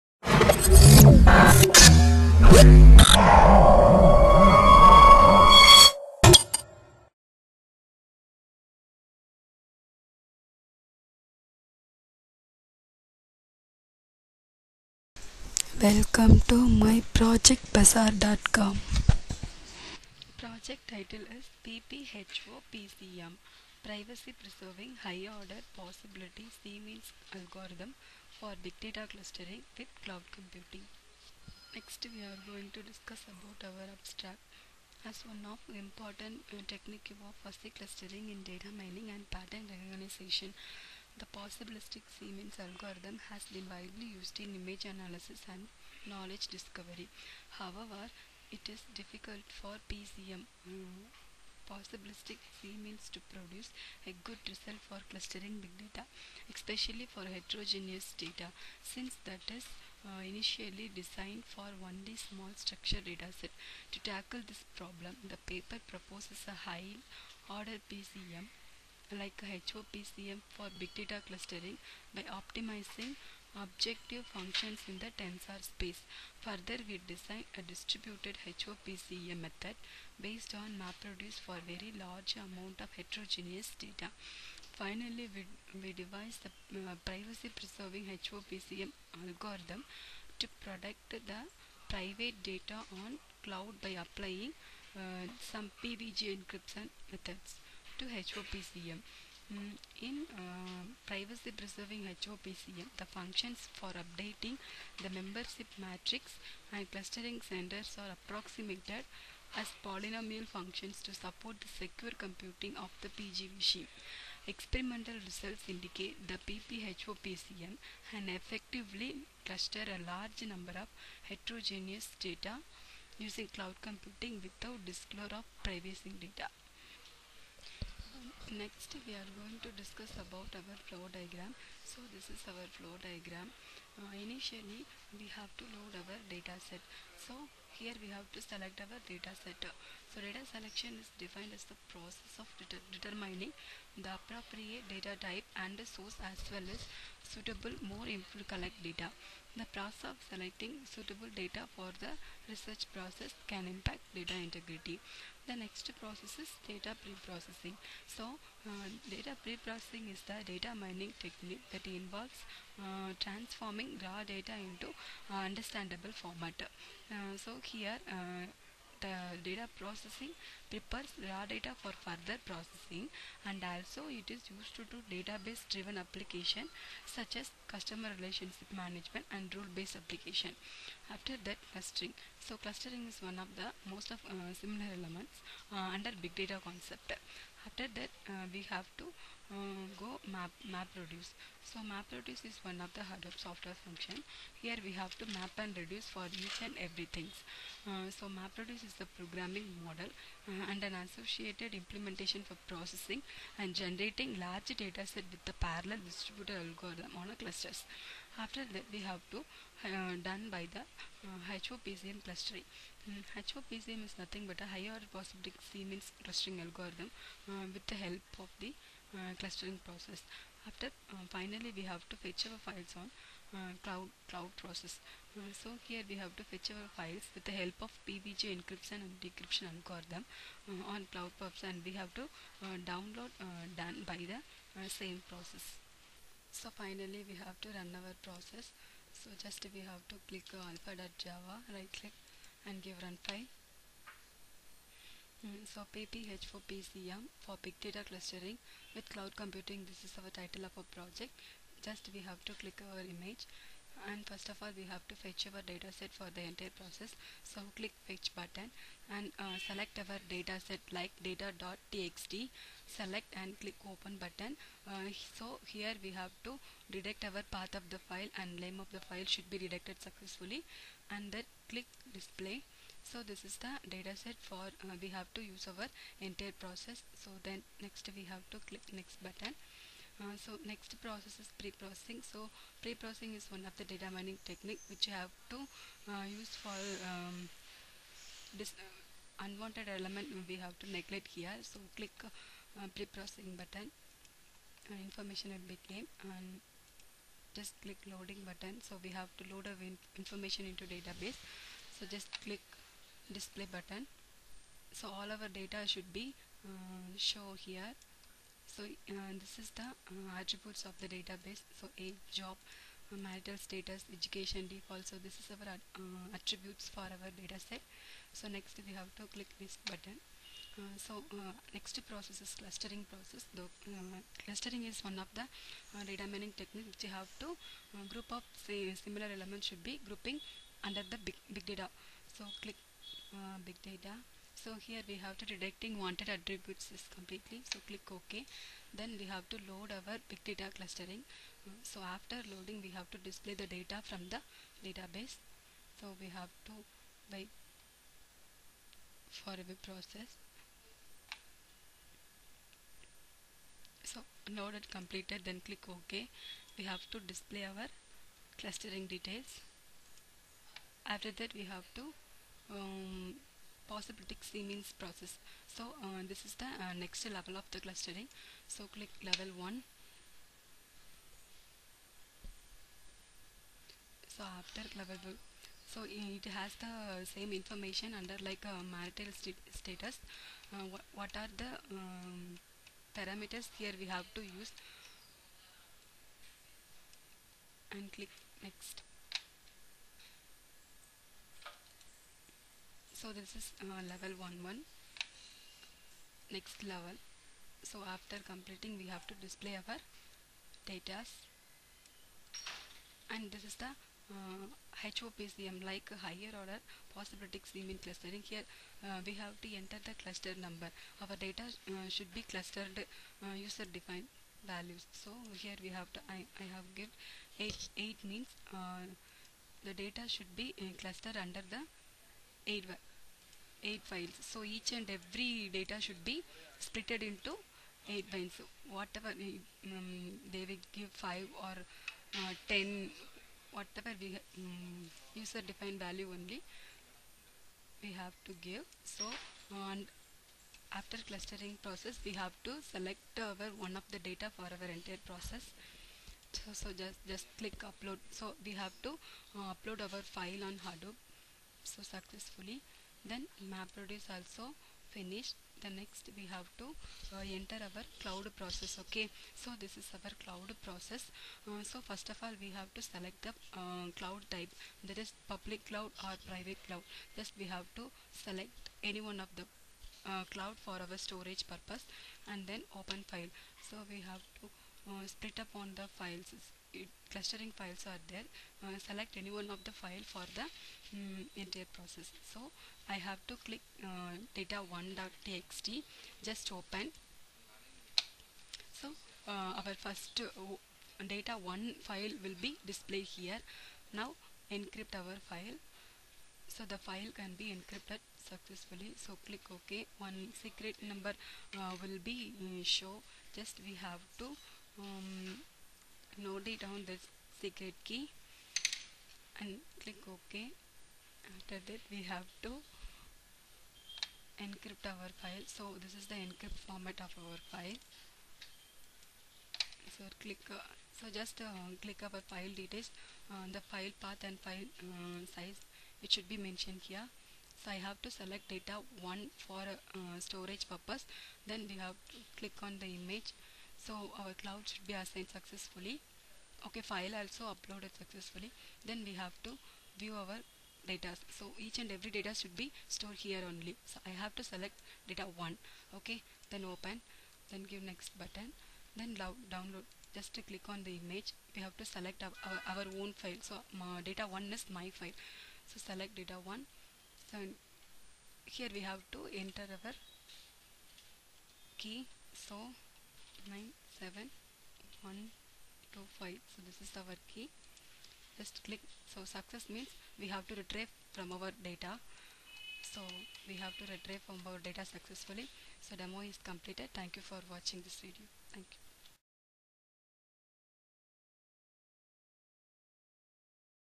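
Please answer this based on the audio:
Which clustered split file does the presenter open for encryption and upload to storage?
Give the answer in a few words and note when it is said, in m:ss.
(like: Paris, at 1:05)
data1.txt, at 8:04.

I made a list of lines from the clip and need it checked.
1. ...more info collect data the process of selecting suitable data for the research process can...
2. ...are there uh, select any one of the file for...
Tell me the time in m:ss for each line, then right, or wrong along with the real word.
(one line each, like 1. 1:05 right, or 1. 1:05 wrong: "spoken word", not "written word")
1. 2:27 right
2. 7:58 right.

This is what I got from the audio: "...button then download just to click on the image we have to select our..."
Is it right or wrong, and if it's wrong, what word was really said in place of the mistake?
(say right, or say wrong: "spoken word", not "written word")
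right.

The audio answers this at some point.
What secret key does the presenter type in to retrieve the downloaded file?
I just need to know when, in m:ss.
9:23.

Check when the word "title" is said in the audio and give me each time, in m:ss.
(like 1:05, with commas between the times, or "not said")
0:20, 4:10.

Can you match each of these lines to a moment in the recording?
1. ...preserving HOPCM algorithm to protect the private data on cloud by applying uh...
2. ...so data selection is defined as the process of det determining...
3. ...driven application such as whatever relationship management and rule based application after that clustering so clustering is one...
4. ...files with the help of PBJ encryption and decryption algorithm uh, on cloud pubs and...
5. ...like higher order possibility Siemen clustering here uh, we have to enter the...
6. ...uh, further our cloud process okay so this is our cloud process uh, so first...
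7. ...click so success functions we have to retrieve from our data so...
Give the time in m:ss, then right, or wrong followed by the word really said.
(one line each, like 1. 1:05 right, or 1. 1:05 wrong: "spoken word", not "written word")
1. 1:27 right
2. 2:20 right
3. 2:55 wrong: "customer", not "whatever"
4. 3:46 right
5. 6:45 right
6. 7:37 wrong: "enter", not "further"
7. 9:28 wrong: "means", not "functions".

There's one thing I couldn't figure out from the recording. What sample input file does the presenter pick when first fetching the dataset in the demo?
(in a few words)
data.txt.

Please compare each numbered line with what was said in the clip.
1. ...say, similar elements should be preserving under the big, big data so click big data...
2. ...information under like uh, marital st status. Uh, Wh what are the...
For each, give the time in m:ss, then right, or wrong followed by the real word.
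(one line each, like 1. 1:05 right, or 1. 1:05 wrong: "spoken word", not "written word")
1. 5:28 wrong: "grouping", not "preserving"
2. 6:17 right.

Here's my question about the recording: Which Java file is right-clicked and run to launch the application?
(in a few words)
alpha.java.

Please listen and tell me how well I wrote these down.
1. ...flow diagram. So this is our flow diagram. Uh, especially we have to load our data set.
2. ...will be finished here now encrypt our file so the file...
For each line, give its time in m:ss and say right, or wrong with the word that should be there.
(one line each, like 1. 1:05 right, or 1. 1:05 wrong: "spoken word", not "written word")
1. 2:10 wrong: "initially", not "especially"
2. 8:12 wrong: "displayed", not "finished".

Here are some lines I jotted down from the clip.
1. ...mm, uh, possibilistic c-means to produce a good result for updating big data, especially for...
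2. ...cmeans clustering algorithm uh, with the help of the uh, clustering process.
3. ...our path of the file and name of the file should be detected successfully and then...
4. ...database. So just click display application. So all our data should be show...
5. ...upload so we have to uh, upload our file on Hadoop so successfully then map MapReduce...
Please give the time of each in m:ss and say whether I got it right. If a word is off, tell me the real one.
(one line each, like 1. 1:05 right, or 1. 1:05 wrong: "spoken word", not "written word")
1. 0:50 wrong: "clustering", not "updating"
2. 3:35 wrong: "means", not "cmeans"
3. 4:27 right
4. 5:00 wrong: "button", not "application"
5. 7:27 right.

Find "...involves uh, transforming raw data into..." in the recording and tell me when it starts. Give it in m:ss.
2:41.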